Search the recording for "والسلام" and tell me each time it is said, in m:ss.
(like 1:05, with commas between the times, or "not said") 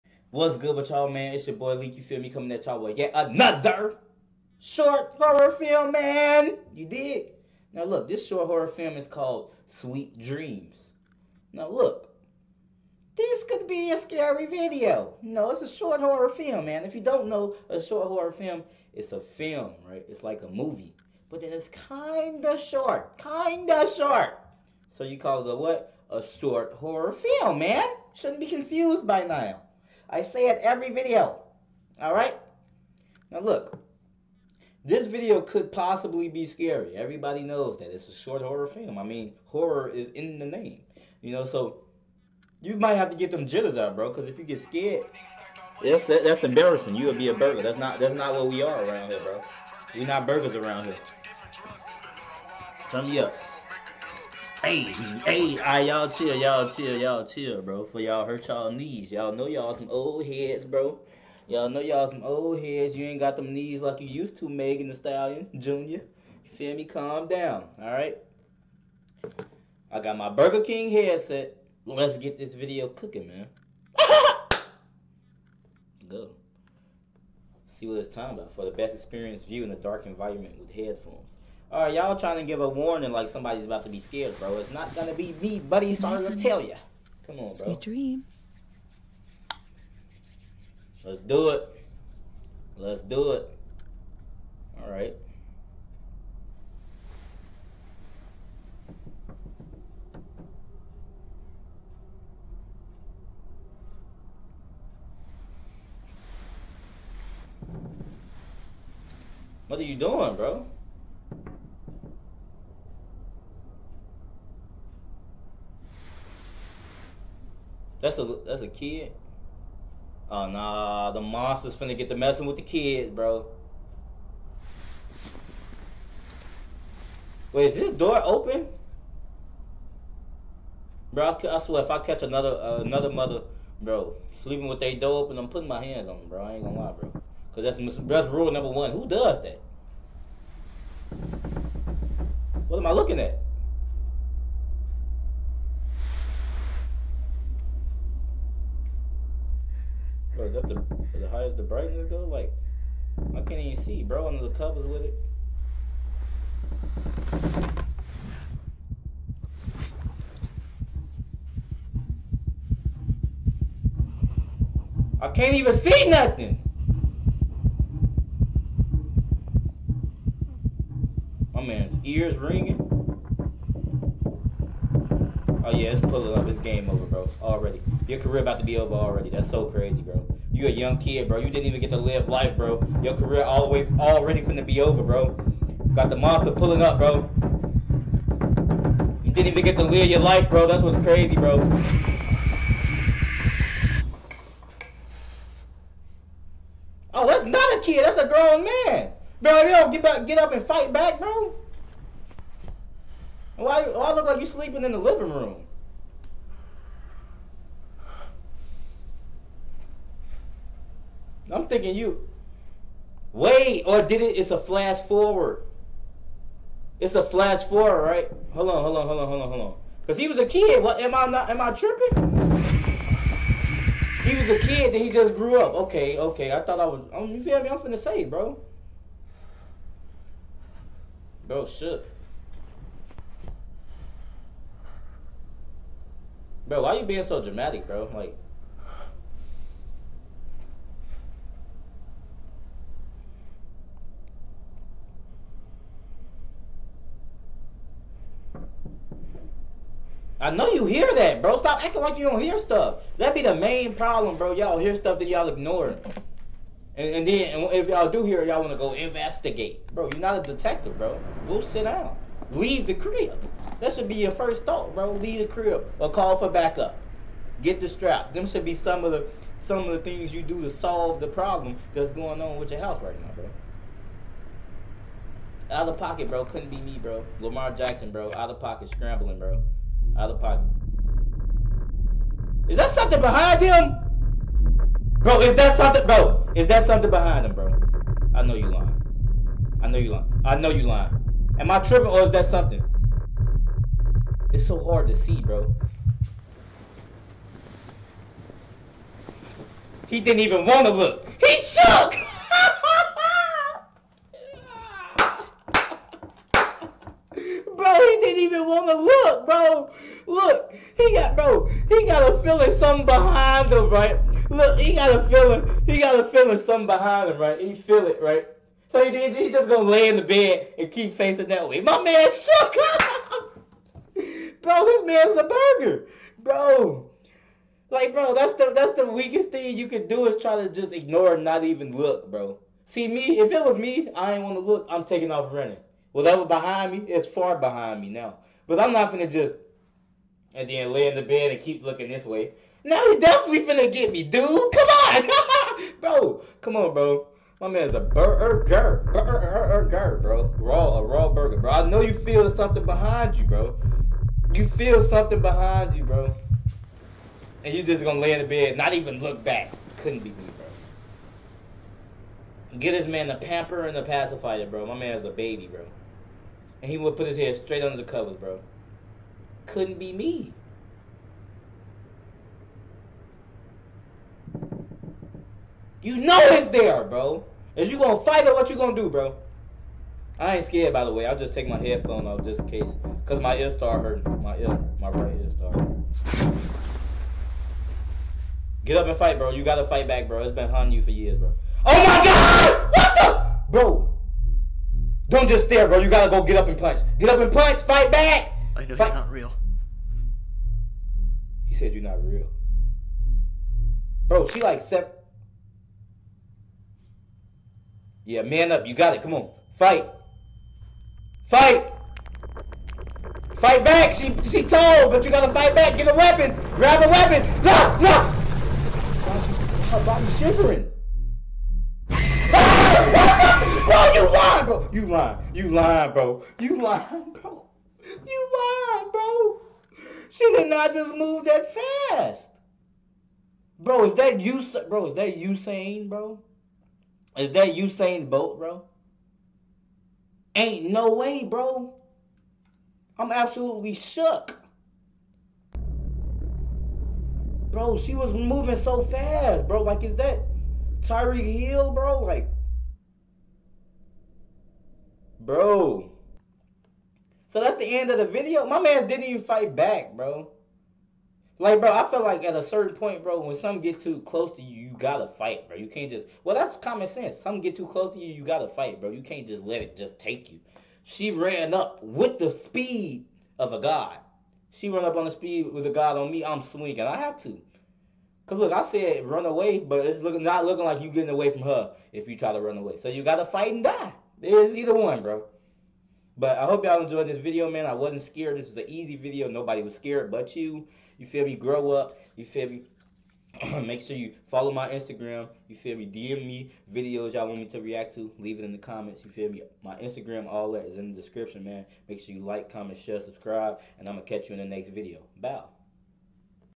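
not said.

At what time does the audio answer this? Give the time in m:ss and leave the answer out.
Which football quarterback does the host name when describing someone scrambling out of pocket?
4:37.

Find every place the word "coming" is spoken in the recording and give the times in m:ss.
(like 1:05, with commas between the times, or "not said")
0:02.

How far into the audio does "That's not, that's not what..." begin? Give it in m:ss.
0:47.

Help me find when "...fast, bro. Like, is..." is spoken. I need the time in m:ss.
7:29.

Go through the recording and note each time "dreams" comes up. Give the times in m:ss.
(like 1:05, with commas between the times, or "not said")
0:10, 1:27.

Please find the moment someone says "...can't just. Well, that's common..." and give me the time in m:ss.
7:45.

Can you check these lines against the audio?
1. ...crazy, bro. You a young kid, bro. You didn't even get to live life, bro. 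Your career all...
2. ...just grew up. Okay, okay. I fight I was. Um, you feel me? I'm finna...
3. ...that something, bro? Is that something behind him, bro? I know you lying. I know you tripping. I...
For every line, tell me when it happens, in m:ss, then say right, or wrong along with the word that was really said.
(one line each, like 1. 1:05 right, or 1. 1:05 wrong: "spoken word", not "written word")
1. 2:59 right
2. 3:45 wrong: "thought", not "fight"
3. 4:45 wrong: "lying", not "tripping".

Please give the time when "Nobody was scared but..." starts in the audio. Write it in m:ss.
8:09.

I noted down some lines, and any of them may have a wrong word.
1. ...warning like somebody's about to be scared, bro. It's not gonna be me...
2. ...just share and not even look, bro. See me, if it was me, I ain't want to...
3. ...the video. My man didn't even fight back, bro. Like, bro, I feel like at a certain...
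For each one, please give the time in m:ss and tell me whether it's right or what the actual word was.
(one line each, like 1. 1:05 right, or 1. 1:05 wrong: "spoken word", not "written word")
1. 1:22 right
2. 5:30 wrong: "ignore", not "share"
3. 7:38 right.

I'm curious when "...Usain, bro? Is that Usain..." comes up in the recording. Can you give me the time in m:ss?
7:15.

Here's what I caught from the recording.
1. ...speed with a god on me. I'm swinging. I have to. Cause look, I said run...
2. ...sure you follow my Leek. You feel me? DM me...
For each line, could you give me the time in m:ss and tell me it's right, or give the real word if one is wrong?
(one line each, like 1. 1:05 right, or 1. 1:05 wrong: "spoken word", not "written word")
1. 7:55 right
2. 8:14 wrong: "Instagram", not "Leek".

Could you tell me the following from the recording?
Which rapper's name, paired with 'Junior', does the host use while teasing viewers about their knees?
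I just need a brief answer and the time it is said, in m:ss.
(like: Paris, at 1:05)
Megan Thee Stallion, at 1:04.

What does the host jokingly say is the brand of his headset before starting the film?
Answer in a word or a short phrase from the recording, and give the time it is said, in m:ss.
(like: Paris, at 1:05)
Burger King, at 1:10.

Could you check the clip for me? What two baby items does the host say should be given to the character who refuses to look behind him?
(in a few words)
A pamper and a pacifier.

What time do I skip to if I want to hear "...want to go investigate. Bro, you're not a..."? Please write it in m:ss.
4:18.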